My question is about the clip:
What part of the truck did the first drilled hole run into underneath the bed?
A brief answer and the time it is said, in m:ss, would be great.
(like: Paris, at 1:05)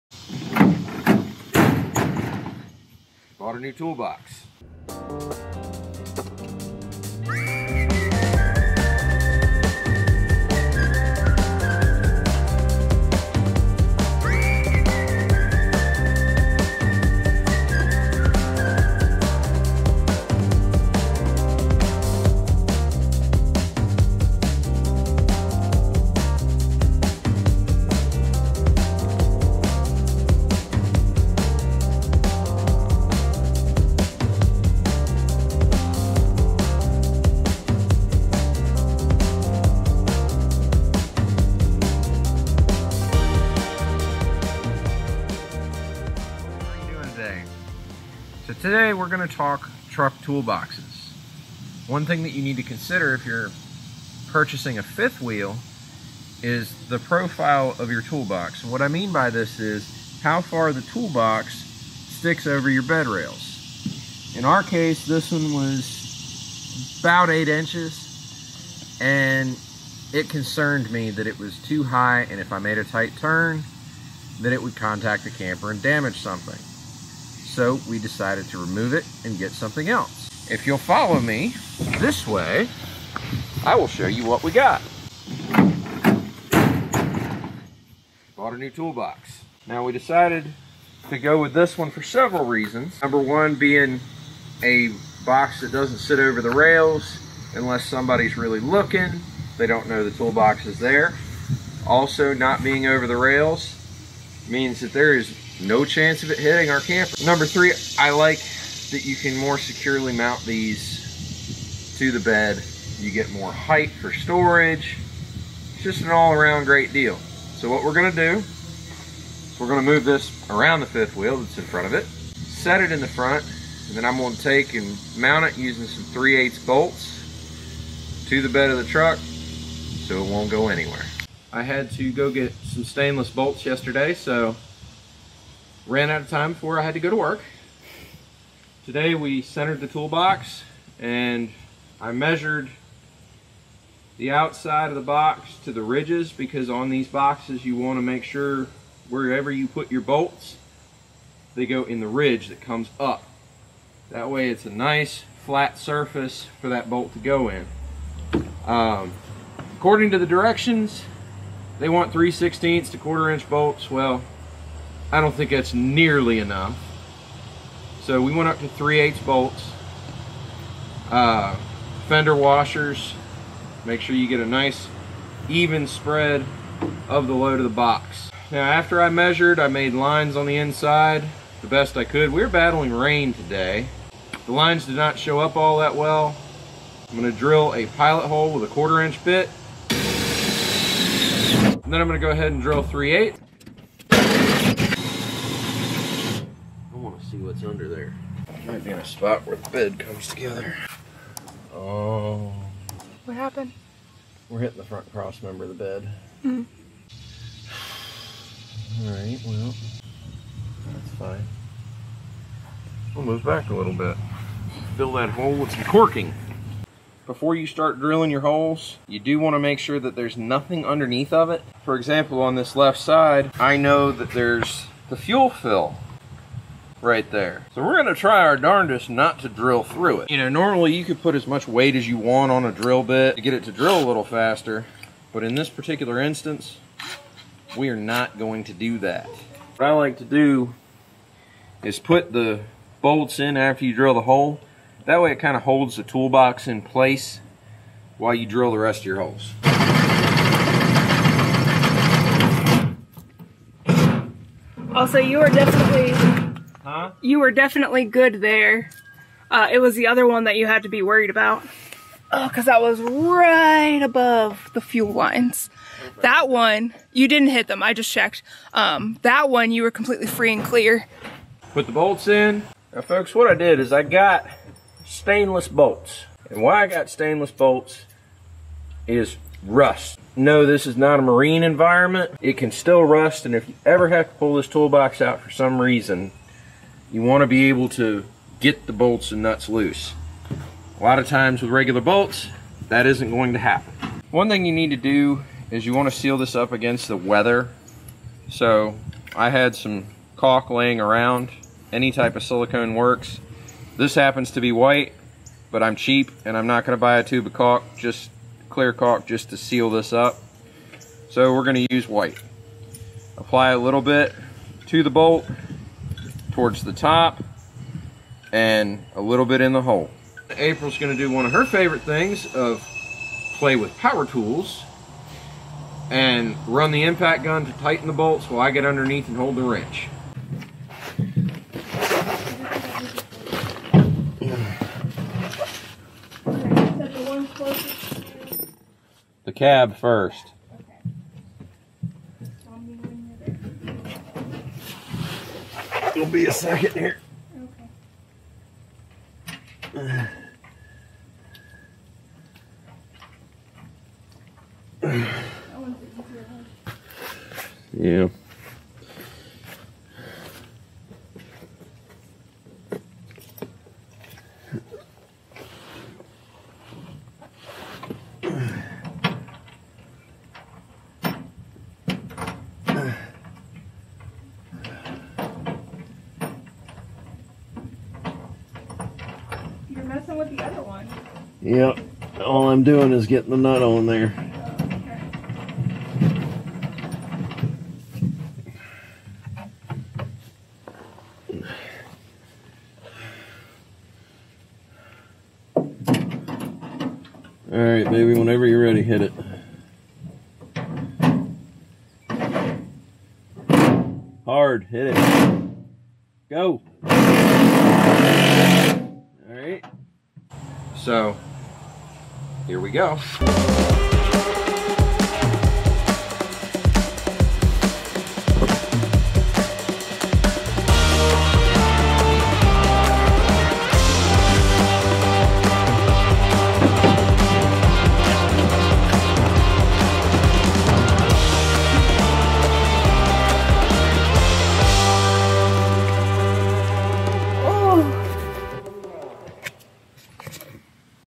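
front cross member, at 3:24.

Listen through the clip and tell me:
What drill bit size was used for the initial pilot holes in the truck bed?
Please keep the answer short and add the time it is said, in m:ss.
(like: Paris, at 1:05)
1/4 inch, at 3:08.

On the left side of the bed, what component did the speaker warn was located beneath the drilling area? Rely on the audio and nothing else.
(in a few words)
fuel fill.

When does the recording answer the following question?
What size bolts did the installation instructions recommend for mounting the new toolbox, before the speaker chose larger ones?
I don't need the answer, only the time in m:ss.
2:42.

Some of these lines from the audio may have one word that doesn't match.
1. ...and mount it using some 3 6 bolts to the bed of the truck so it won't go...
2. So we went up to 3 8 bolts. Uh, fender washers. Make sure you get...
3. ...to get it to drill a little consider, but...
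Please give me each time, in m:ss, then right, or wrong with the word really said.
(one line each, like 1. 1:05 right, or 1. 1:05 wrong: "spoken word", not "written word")
1. 2:04 wrong: "8", not "6"
2. 2:48 right
3. 3:53 wrong: "faster", not "consider".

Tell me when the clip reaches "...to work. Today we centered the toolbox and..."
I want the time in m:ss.
2:17.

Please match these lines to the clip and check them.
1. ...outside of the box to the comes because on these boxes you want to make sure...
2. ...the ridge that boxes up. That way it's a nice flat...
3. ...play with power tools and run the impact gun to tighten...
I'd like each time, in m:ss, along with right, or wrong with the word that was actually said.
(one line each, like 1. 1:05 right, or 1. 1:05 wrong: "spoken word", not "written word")
1. 2:24 wrong: "ridges", not "comes"
2. 2:31 wrong: "comes", not "boxes"
3. 5:23 right.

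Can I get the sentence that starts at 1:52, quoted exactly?
You get more height for storage.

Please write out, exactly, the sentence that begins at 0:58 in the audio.
what I mean by this is how far the toolbox sticks over your bed rails.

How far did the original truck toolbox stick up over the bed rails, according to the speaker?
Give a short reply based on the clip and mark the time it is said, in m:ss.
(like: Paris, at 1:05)
about 8 inches, at 1:06.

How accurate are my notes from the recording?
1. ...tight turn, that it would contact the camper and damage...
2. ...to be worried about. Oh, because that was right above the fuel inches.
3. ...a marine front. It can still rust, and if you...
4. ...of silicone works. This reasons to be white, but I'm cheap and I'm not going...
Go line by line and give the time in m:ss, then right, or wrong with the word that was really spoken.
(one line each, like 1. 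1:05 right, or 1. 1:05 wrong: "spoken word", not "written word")
1. 1:12 right
2. 4:20 wrong: "lines", not "inches"
3. 4:41 wrong: "environment", not "front"
4. 5:02 wrong: "happens", not "reasons".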